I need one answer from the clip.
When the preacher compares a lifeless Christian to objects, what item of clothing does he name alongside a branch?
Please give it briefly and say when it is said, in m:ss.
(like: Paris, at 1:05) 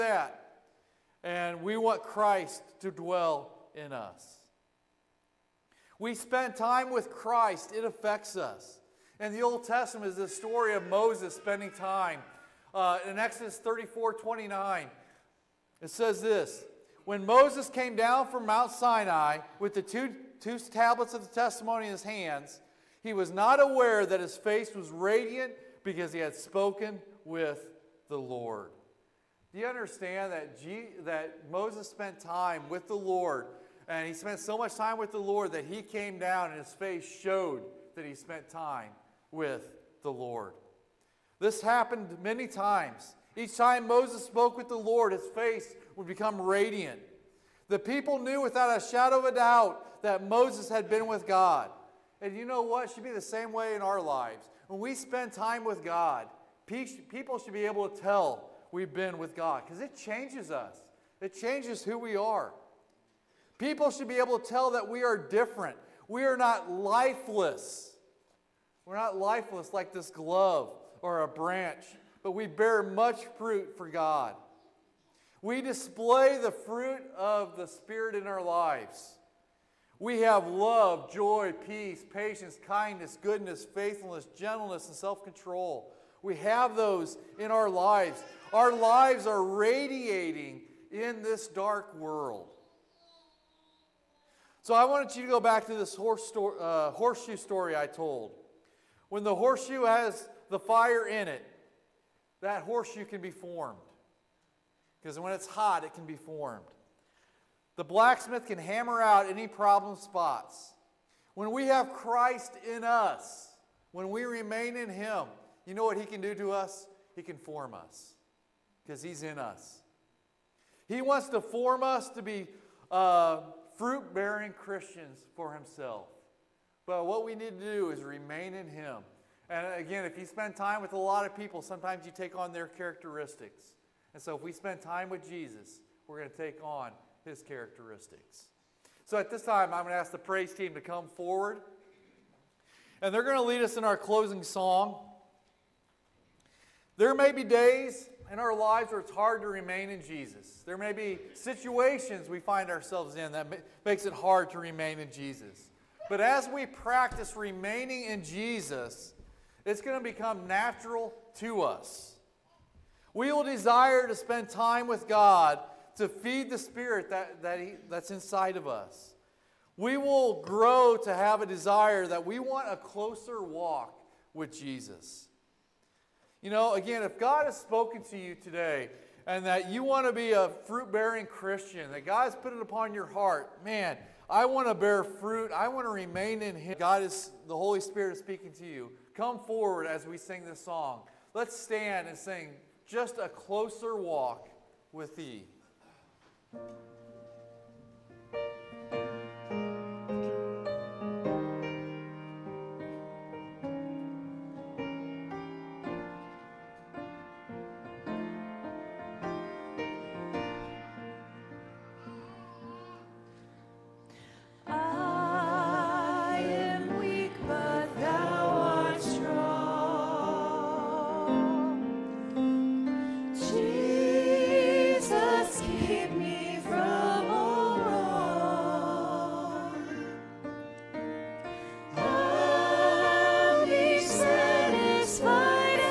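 Glove, at 1:10.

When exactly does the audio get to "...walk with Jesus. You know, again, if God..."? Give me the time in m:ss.
2:53.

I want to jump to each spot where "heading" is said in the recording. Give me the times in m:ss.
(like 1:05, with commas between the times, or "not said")
not said.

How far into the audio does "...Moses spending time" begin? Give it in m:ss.
0:10.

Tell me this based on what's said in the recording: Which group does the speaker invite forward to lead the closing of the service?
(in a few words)
The praise team.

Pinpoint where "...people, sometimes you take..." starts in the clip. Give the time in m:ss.
2:11.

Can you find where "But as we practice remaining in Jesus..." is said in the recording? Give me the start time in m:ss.
2:36.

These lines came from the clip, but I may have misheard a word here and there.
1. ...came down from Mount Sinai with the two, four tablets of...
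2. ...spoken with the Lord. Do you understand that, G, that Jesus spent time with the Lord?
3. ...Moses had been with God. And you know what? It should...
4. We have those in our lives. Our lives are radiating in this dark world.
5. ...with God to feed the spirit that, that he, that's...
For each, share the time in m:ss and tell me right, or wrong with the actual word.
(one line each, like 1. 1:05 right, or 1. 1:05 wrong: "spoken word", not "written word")
1. 0:17 wrong: "two", not "four"
2. 0:26 wrong: "Moses", not "Jesus"
3. 0:50 right
4. 1:26 right
5. 2:44 right.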